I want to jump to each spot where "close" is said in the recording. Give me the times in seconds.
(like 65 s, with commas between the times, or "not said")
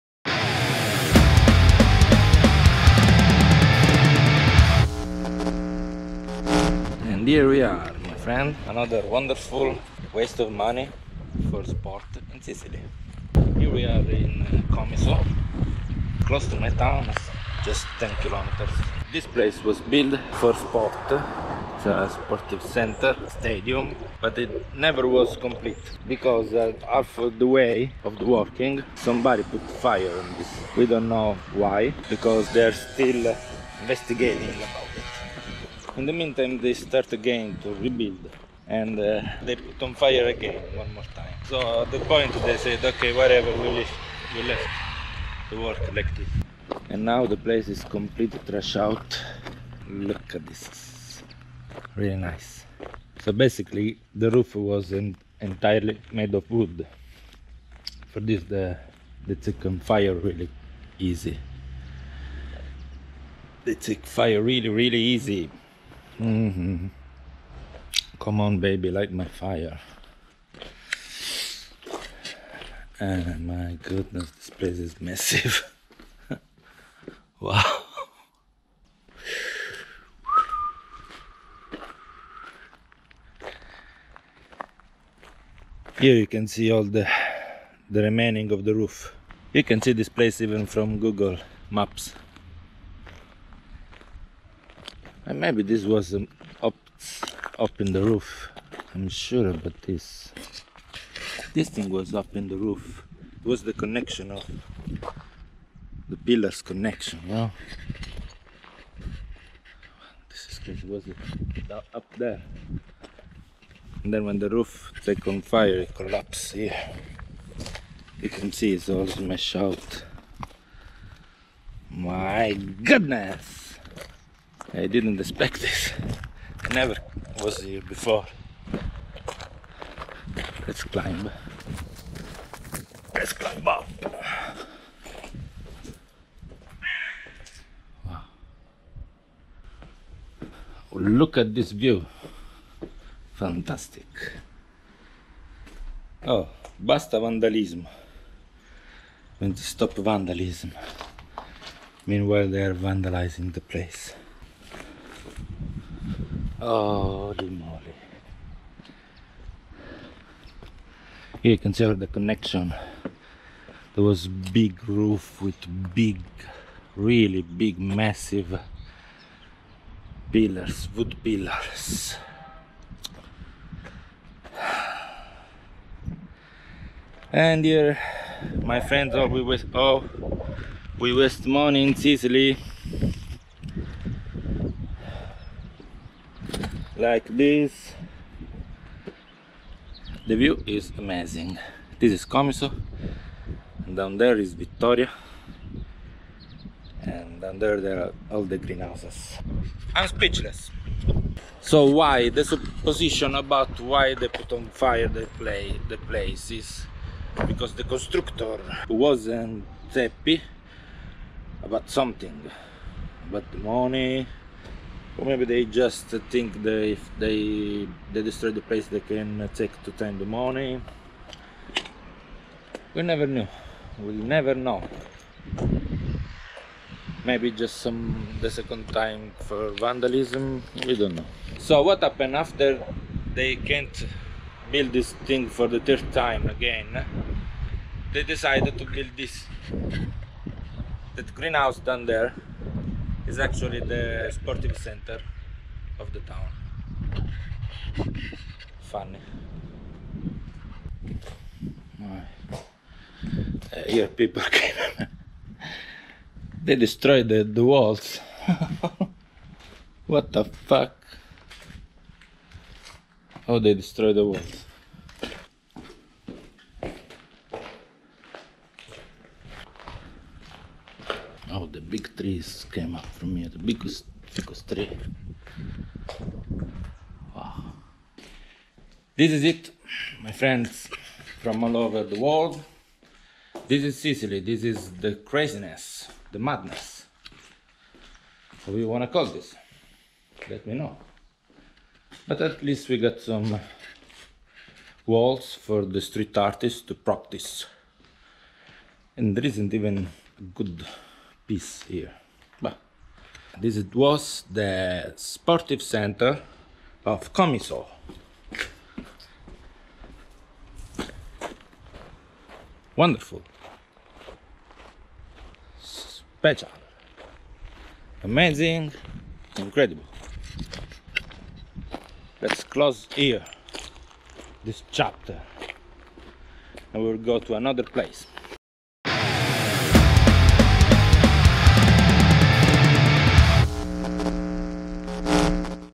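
16 s, 322 s.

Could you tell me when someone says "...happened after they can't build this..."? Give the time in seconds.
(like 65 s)
232 s.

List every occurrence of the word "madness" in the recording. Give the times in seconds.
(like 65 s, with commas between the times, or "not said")
286 s.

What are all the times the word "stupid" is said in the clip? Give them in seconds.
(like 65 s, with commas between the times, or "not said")
not said.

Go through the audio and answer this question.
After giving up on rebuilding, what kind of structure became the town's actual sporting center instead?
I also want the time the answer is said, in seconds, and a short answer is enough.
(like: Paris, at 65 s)
greenhouse, at 241 s.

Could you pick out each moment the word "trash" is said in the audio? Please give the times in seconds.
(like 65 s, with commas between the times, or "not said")
48 s.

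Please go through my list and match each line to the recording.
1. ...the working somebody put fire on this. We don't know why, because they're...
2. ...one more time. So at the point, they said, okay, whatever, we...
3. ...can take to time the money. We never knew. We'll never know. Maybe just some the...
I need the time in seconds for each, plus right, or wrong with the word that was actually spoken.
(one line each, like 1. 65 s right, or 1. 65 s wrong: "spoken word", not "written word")
1. 28 s right
2. 40 s right
3. 219 s right.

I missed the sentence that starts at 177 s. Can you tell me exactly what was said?
And here, my friends, oh, we waste, oh, we waste money in Sicily.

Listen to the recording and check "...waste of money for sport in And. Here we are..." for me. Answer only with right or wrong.
wrong.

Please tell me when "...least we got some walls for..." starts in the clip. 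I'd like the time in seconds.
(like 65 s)
292 s.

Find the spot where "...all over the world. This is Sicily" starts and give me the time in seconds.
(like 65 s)
281 s.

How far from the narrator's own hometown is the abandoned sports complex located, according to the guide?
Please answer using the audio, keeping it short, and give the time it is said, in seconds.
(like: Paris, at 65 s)
10 kilometers, at 17 s.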